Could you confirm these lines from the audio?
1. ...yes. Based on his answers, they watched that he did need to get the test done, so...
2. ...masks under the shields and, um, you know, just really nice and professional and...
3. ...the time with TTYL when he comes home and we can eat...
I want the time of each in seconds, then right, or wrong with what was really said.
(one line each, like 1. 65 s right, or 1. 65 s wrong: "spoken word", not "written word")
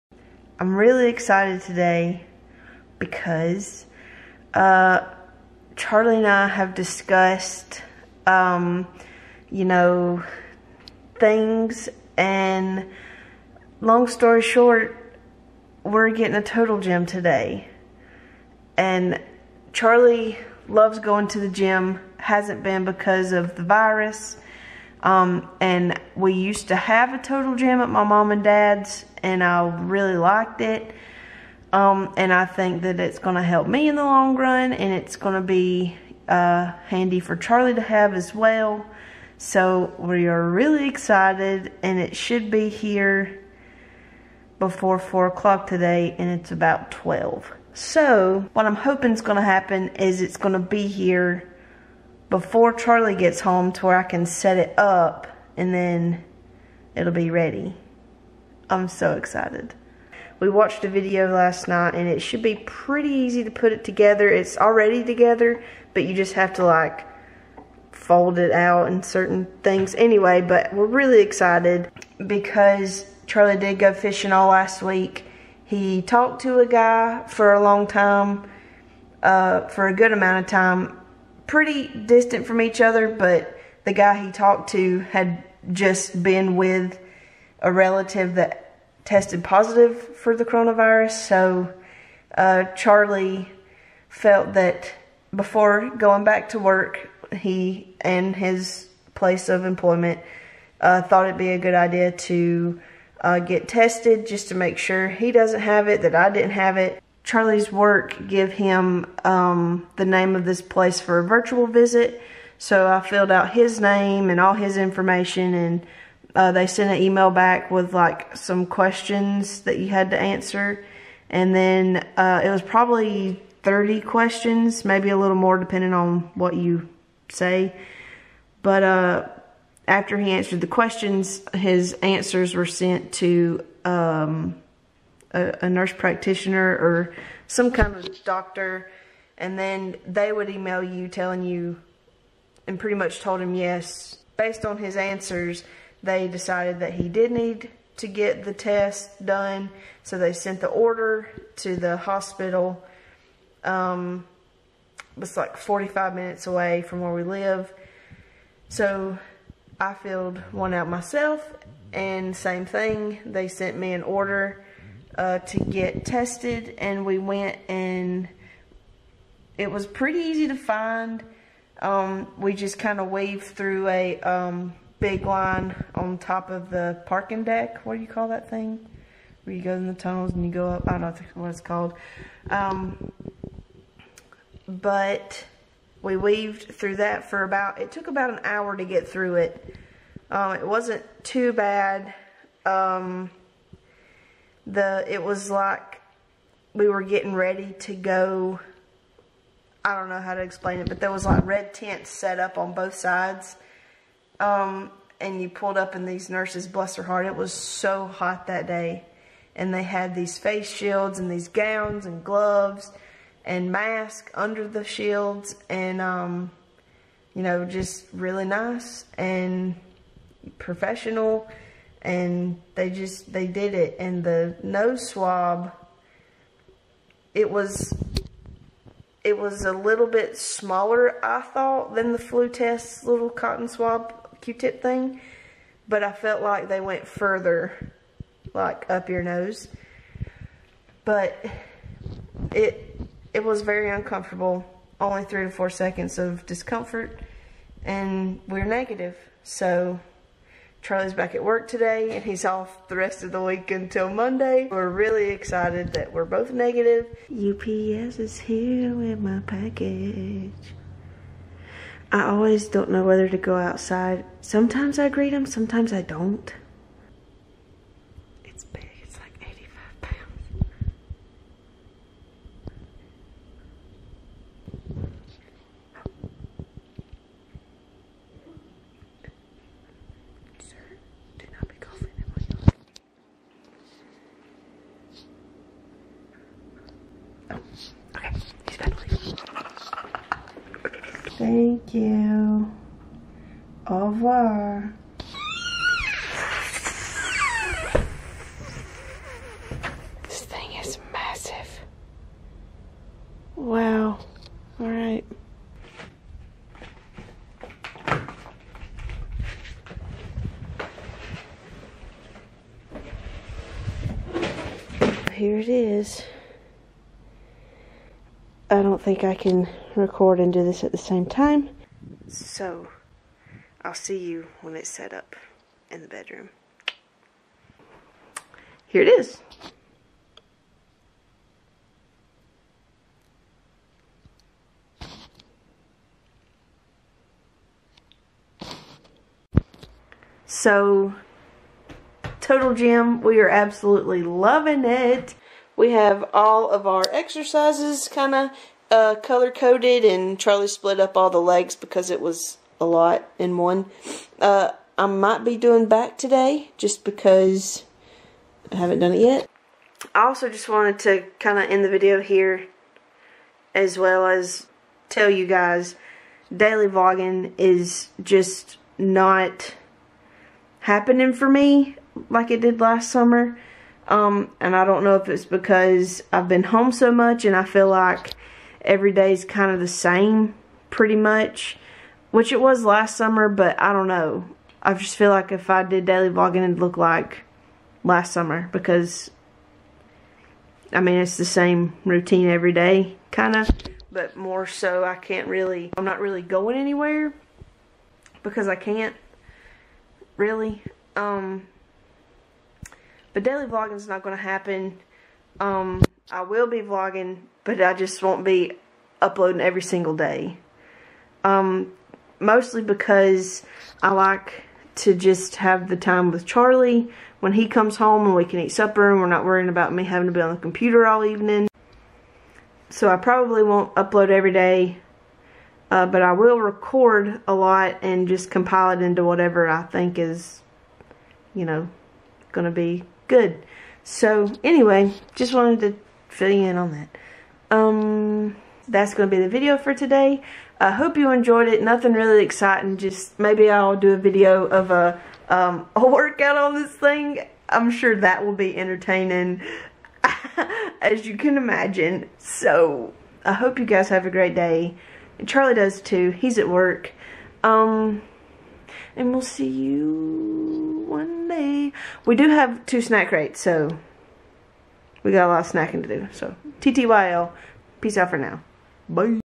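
1. 143 s wrong: "decided", not "watched"
2. 213 s right
3. 415 s wrong: "Charlie", not "TTYL".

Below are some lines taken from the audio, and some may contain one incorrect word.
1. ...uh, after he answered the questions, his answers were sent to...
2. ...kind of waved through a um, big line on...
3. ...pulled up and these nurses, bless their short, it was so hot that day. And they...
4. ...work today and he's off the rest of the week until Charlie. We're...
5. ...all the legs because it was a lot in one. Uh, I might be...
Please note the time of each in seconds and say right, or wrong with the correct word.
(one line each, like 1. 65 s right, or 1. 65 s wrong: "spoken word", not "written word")
1. 128 s right
2. 172 s right
3. 205 s wrong: "heart", not "short"
4. 251 s wrong: "Monday", not "Charlie"
5. 351 s right.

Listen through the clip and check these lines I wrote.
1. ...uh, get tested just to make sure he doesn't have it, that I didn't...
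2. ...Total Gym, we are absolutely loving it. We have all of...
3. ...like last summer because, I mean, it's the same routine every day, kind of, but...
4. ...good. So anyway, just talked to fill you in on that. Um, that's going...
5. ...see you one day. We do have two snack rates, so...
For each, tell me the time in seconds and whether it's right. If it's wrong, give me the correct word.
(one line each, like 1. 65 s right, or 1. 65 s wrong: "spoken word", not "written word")
1. 103 s right
2. 342 s right
3. 386 s right
4. 433 s wrong: "wanted", not "talked"
5. 459 s right.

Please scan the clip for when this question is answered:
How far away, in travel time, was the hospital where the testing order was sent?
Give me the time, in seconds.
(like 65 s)
155 s.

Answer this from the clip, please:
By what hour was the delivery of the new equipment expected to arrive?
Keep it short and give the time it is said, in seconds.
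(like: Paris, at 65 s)
4 o'clock, at 44 s.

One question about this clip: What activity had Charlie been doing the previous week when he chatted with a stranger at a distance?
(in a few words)
fishing.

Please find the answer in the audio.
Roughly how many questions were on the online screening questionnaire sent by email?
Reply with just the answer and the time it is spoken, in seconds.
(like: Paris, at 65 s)
30, at 123 s.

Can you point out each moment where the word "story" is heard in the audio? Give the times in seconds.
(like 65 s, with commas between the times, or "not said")
14 s.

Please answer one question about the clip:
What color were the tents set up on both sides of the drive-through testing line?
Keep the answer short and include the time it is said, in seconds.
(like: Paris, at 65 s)
red, at 201 s.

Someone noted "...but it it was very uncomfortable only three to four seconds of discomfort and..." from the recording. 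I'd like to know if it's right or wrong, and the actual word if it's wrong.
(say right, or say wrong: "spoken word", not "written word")
right.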